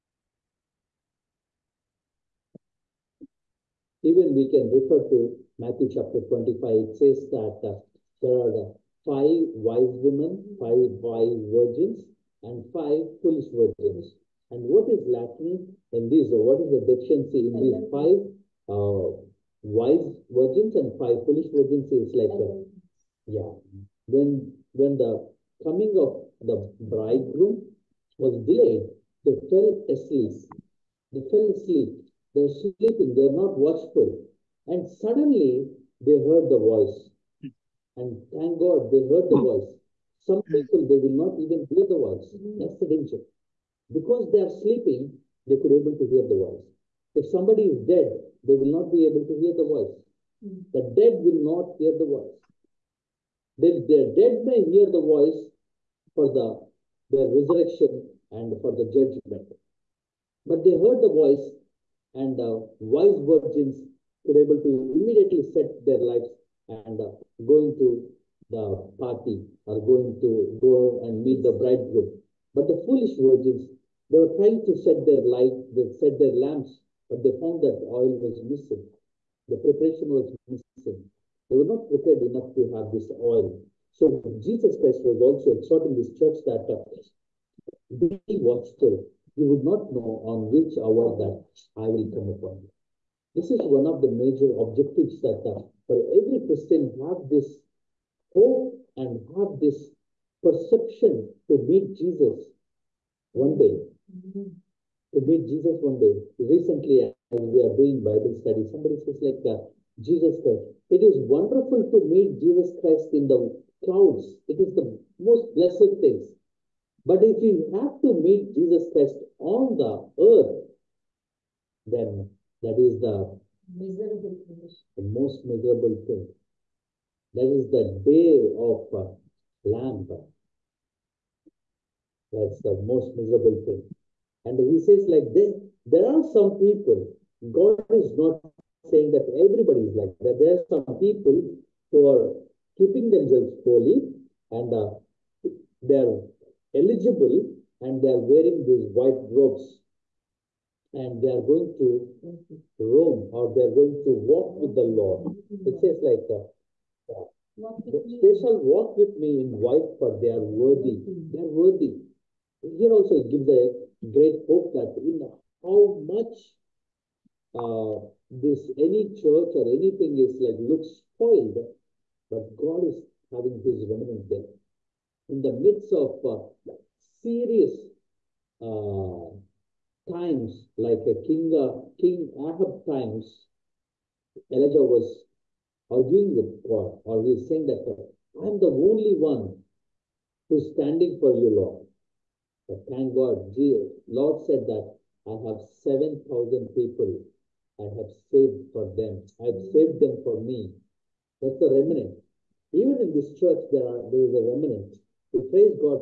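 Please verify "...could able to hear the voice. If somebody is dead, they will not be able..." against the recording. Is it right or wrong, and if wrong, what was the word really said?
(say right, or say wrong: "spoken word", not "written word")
right.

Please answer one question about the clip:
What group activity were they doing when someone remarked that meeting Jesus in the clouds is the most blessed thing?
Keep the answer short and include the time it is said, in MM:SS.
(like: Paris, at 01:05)
Bible study, at 01:48.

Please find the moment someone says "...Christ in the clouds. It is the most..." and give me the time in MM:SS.
01:52.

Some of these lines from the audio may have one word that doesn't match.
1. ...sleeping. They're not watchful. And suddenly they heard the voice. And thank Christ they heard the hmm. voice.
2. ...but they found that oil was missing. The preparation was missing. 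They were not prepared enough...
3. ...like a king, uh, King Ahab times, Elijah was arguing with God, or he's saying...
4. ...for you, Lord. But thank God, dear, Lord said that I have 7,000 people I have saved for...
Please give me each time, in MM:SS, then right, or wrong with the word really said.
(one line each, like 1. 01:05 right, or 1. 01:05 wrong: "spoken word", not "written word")
1. 00:32 wrong: "God", not "Christ"
2. 01:17 right
3. 03:00 right
4. 03:11 right.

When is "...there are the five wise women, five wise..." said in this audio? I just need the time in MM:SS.
00:08.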